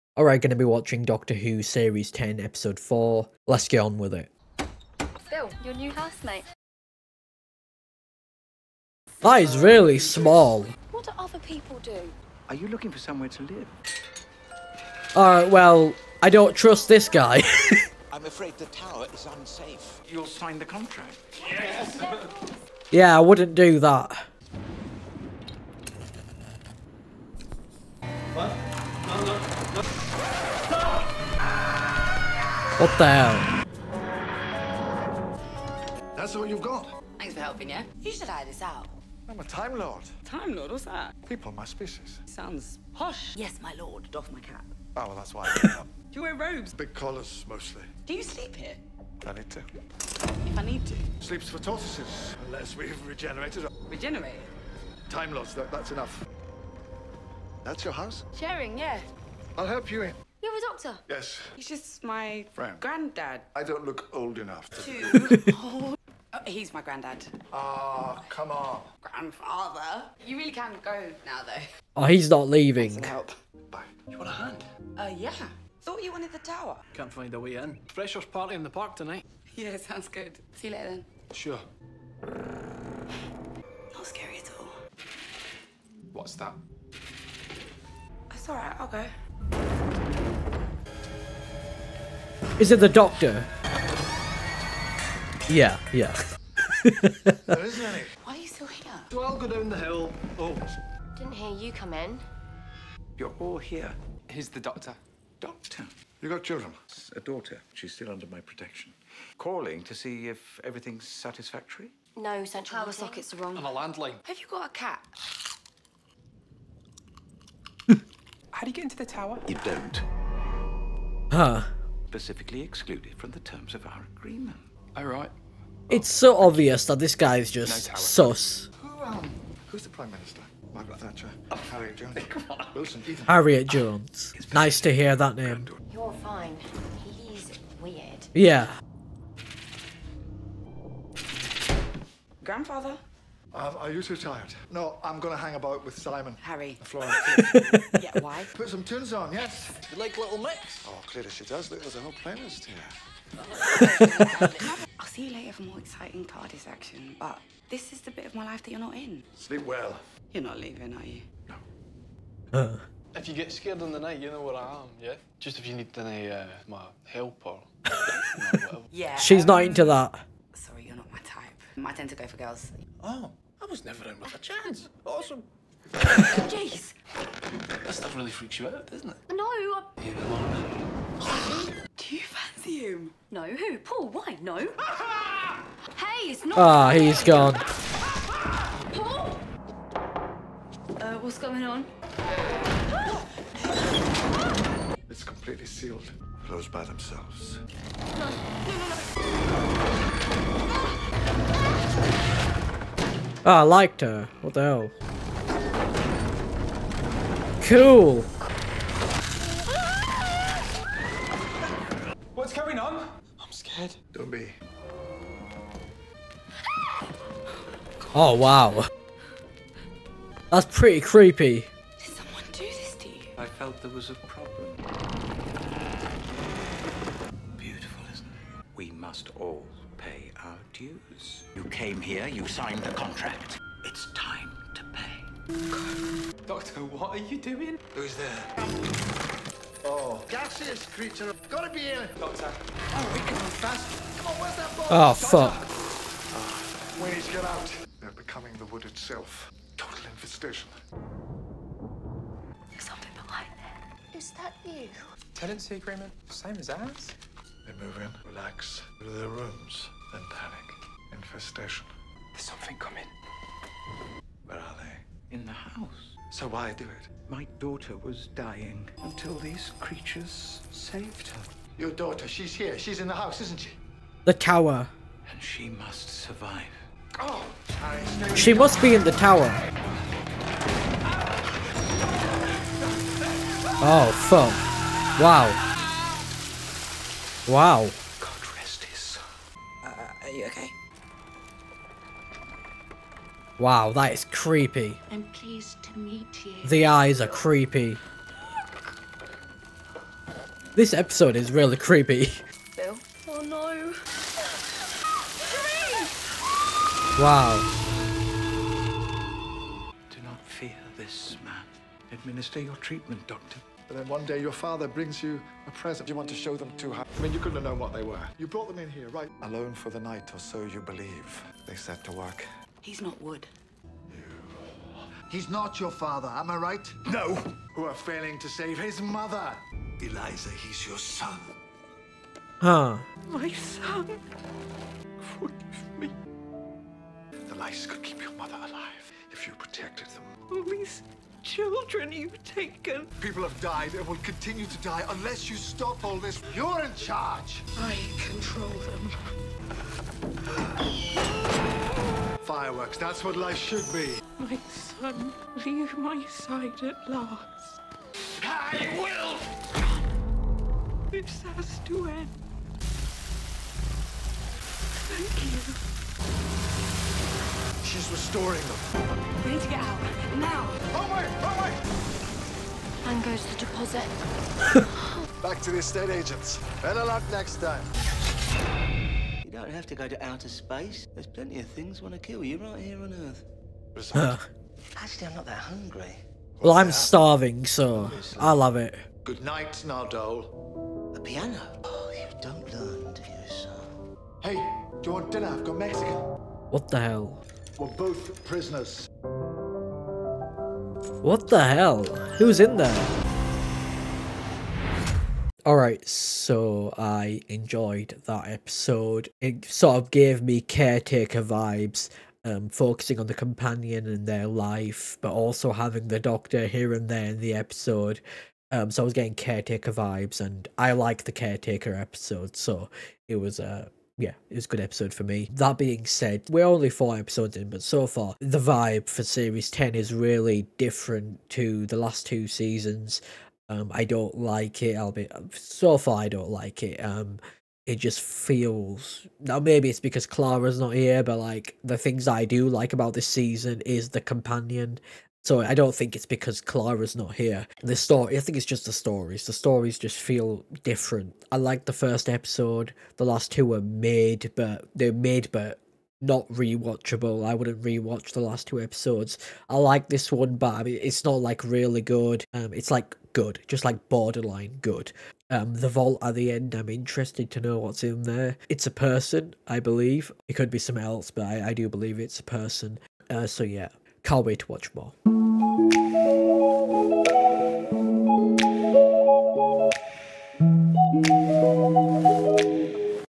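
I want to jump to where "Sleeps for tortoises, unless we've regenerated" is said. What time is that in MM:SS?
00:51.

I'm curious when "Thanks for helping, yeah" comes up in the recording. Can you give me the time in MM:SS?
00:37.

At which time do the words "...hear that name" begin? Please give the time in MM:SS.
02:14.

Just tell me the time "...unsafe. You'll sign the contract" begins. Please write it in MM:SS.
00:19.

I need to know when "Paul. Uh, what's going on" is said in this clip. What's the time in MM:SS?
03:08.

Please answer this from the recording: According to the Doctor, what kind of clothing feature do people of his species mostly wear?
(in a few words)
Big collars.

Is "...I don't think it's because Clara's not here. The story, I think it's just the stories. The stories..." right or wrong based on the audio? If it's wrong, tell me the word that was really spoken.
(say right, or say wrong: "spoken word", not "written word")
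right.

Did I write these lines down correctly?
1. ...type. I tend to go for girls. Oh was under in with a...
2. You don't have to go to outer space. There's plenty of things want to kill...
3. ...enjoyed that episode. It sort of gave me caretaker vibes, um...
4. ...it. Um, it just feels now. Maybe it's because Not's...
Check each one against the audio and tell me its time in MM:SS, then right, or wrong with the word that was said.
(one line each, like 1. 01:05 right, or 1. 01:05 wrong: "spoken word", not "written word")
1. 02:51 wrong: "never", not "under"
2. 06:19 right
3. 06:47 right
4. 07:16 wrong: "Clara", not "Not".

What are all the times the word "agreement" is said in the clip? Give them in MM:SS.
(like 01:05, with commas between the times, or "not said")
02:04, 04:15.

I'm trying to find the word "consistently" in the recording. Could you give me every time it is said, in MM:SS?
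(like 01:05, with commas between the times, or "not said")
not said.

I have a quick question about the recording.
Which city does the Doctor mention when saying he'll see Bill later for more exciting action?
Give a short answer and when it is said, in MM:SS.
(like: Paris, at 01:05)
Cardiff, at 02:36.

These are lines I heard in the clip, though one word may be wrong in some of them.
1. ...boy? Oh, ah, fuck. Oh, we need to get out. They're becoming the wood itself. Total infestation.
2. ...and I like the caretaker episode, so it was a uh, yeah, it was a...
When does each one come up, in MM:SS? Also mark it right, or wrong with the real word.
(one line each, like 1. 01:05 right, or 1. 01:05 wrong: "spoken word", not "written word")
1. 04:04 right
2. 07:00 right.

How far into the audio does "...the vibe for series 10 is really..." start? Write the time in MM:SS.
07:08.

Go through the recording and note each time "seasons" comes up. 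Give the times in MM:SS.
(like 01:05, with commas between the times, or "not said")
07:12, 07:23.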